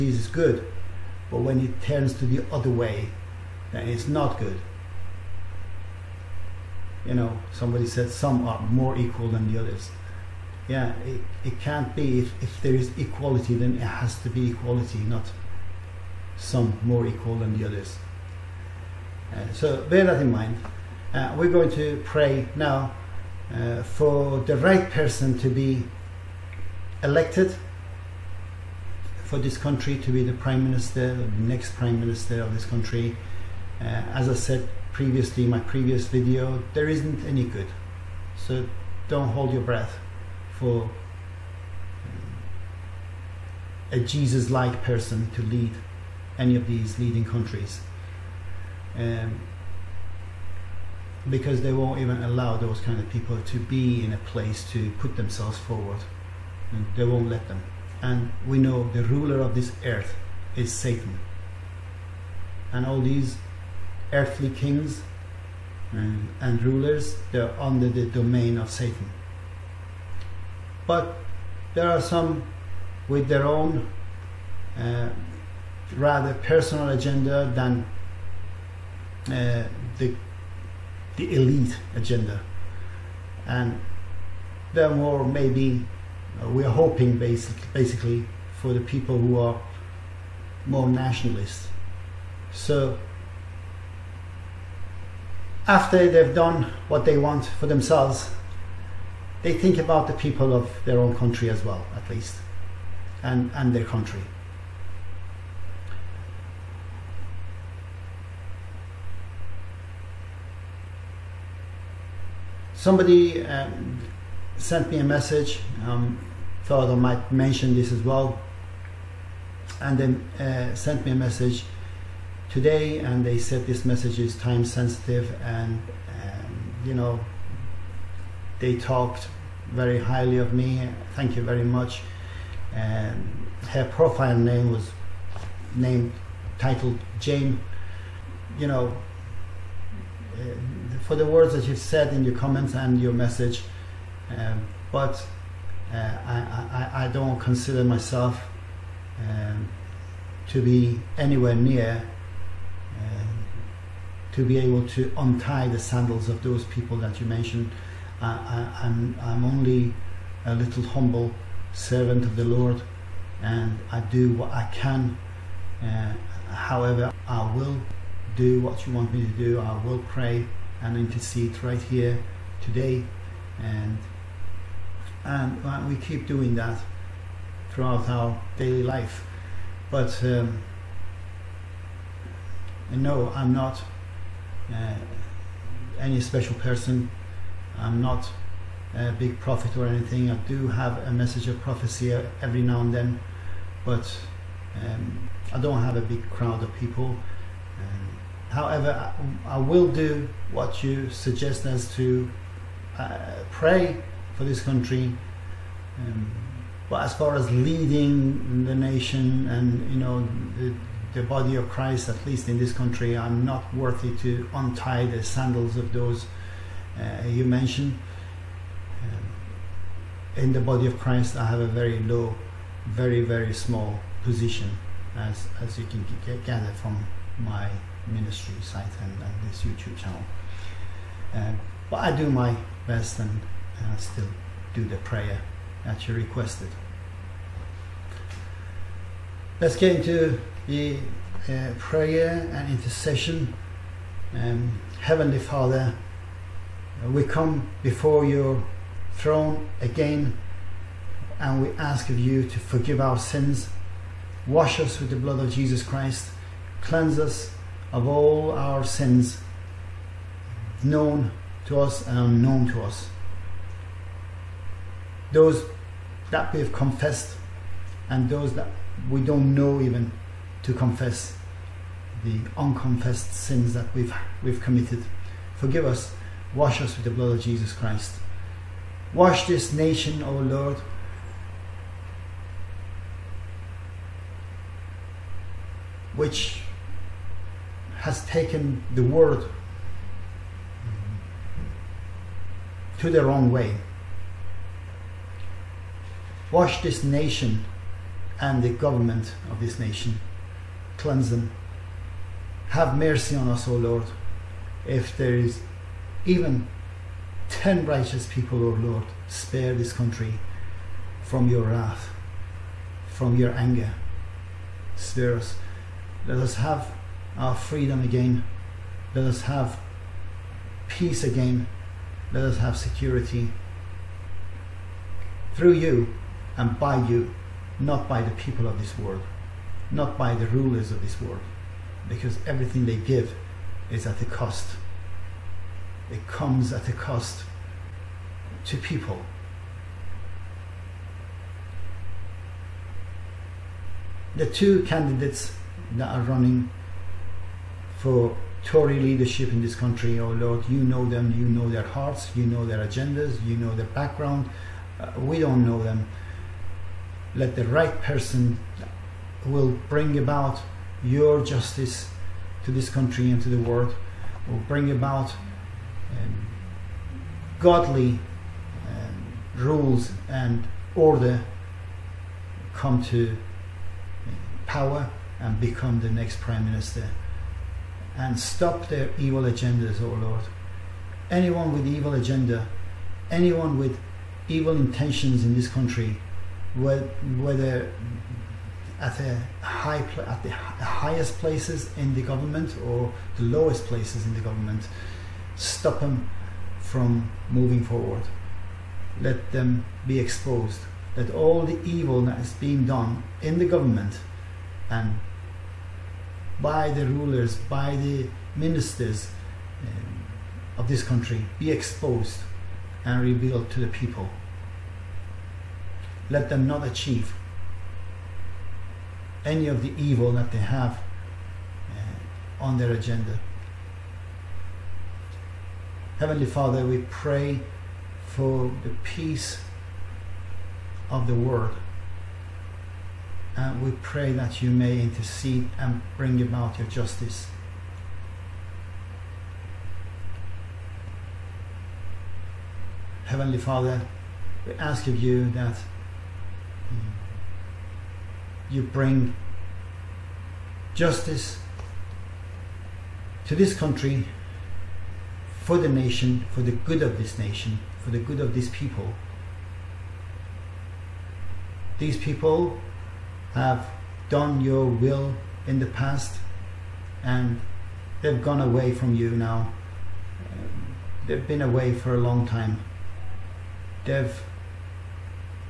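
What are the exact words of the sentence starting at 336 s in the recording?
It comes at a cost to people.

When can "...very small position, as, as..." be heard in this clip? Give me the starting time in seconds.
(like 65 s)
223 s.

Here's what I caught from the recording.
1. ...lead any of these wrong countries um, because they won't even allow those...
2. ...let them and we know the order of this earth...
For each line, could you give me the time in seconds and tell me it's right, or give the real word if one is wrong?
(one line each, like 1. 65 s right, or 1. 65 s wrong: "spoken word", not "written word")
1. 45 s wrong: "leading", not "wrong"
2. 57 s wrong: "ruler", not "order".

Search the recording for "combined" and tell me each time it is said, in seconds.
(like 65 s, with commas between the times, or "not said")
not said.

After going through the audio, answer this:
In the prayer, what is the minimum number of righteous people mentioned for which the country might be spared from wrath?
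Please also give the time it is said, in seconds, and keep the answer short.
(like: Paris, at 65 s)
10, at 307 s.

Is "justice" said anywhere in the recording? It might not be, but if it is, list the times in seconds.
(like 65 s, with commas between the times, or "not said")
361 s, 436 s, 450 s.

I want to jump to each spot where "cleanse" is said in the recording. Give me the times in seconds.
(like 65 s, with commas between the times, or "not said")
256 s, 301 s.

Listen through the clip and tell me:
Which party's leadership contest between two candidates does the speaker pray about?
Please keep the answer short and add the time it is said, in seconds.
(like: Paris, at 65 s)
Tory, at 348 s.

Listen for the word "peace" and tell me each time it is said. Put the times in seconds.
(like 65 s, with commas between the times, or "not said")
320 s, 429 s.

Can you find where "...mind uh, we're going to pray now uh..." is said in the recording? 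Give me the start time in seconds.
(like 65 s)
20 s.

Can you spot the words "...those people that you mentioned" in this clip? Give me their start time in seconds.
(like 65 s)
156 s.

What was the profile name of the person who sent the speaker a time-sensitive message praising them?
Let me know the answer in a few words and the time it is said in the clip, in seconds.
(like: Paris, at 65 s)
Jane, at 137 s.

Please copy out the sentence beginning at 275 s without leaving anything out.
Forgive us, wash us with the blood of Jesus Christ.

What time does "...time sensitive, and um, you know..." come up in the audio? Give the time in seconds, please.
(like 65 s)
124 s.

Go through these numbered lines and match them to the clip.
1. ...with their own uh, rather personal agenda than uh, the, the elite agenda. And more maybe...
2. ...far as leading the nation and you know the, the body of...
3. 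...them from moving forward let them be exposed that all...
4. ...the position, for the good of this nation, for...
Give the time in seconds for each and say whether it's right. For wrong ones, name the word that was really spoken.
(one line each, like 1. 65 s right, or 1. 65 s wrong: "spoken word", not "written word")
1. 73 s right
2. 207 s right
3. 395 s right
4. 455 s wrong: "nation", not "position".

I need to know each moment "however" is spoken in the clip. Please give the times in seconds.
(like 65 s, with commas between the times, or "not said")
166 s, 198 s.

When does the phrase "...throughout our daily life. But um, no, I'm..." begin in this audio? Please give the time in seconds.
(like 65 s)
177 s.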